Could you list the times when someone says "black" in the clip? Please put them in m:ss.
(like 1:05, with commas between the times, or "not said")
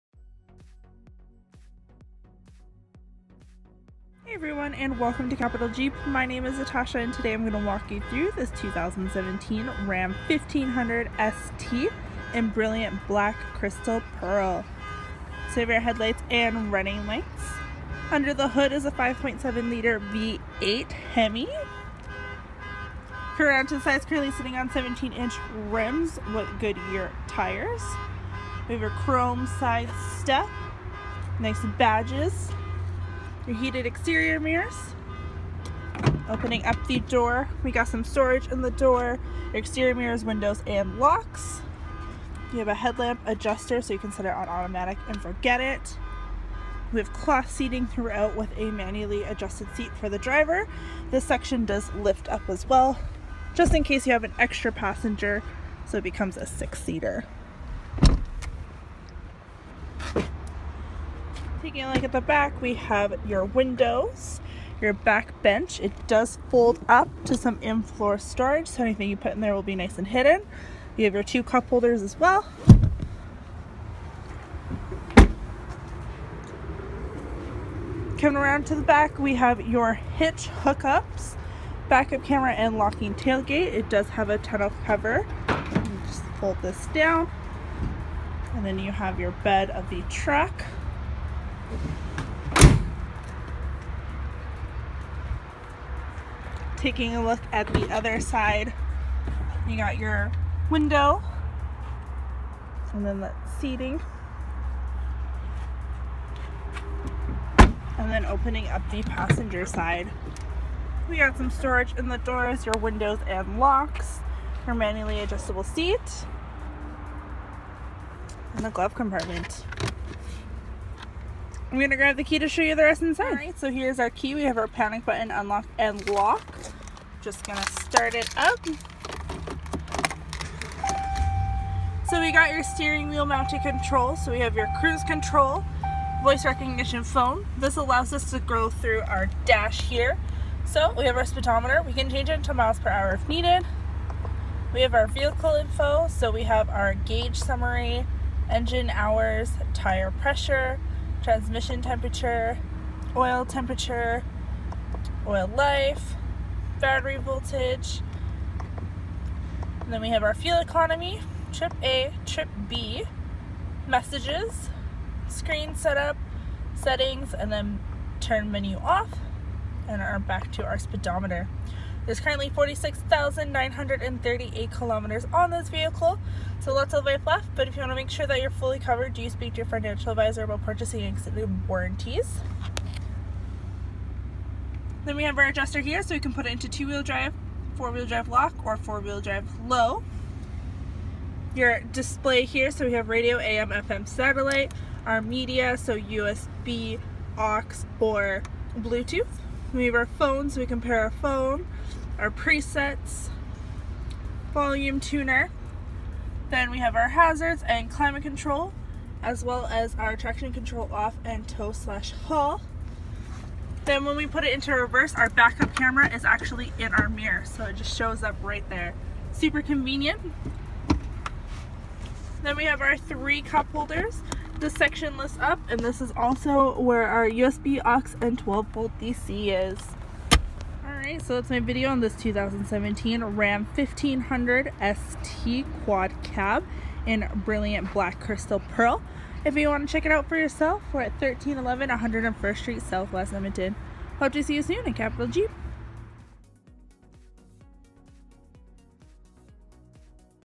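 0:13, 3:57.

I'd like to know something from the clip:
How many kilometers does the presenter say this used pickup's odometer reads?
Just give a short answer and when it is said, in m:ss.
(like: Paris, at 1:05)
46,938, at 2:52.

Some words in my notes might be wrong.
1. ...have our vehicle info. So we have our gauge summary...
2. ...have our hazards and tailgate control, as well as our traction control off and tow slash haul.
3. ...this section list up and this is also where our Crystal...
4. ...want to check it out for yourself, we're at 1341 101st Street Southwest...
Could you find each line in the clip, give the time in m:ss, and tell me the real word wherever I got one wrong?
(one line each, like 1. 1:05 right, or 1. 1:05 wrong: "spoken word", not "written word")
1. 2:24 right
2. 3:26 wrong: "climate", not "tailgate"
3. 3:44 wrong: "USB", not "Crystal"
4. 3:59 wrong: "1311", not "1341".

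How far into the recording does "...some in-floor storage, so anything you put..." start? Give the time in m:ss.
1:07.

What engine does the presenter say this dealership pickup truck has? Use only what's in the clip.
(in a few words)
5.7 liter V8 Hemi.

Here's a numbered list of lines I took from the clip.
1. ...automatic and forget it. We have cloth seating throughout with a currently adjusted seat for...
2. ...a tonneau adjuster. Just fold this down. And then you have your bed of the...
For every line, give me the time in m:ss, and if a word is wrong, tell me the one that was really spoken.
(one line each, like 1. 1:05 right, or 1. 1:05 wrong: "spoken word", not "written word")
1. 0:44 wrong: "manually", not "currently"
2. 1:24 wrong: "cover", not "adjuster".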